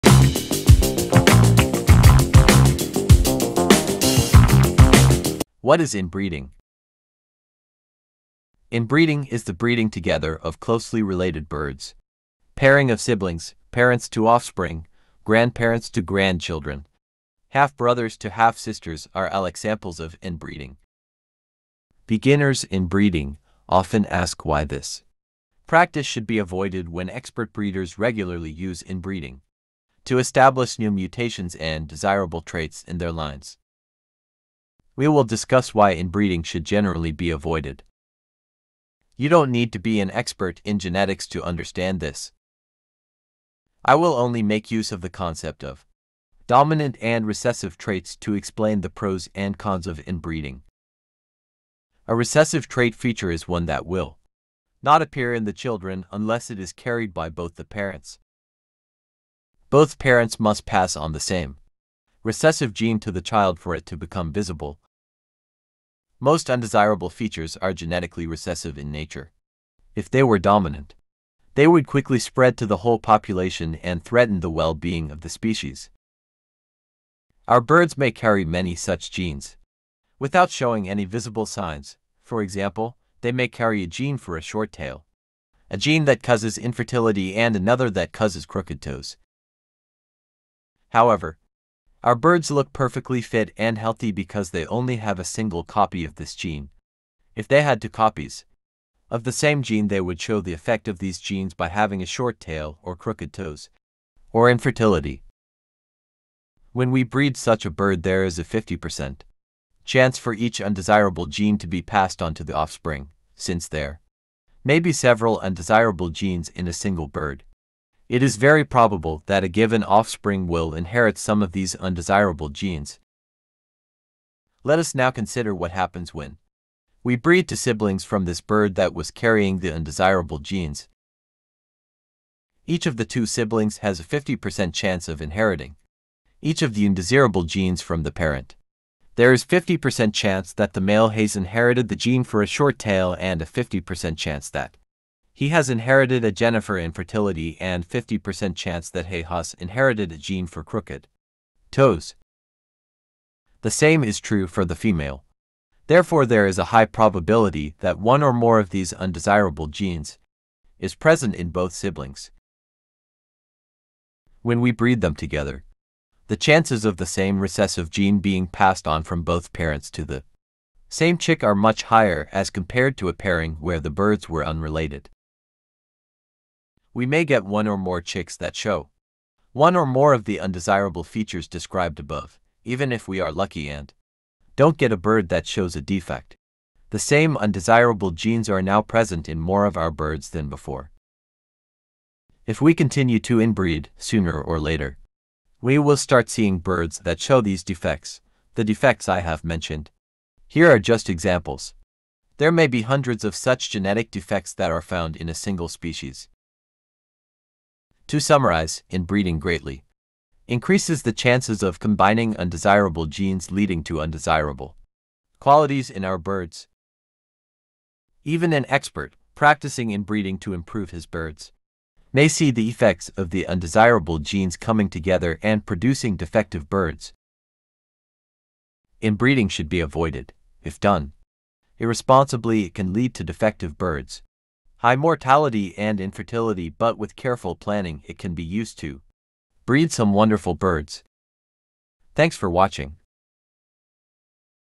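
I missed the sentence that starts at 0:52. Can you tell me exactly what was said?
A recessive trait feature is one that will not appear in the children unless it is carried by both the parents.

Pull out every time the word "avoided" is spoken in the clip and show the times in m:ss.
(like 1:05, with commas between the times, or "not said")
0:26, 0:37, 3:49.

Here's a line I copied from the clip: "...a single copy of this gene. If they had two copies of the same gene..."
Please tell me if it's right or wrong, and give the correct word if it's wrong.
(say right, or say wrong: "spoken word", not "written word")
right.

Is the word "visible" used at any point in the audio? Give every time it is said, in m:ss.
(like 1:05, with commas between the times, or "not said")
1:04, 1:21.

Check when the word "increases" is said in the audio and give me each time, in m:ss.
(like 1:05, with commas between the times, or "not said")
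3:30.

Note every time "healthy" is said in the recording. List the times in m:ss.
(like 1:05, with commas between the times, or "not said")
1:33.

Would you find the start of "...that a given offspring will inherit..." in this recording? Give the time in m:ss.
1:59.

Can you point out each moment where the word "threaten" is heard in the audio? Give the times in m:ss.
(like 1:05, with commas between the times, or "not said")
1:14.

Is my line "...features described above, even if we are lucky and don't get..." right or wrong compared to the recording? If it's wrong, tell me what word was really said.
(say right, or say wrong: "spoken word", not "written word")
right.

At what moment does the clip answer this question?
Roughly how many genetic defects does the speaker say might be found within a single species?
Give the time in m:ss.
3:22.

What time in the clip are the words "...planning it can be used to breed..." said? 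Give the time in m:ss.
3:57.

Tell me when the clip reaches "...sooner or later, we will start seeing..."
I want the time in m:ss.
3:13.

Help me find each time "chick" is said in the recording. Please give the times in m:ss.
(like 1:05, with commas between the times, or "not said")
2:51, 2:58.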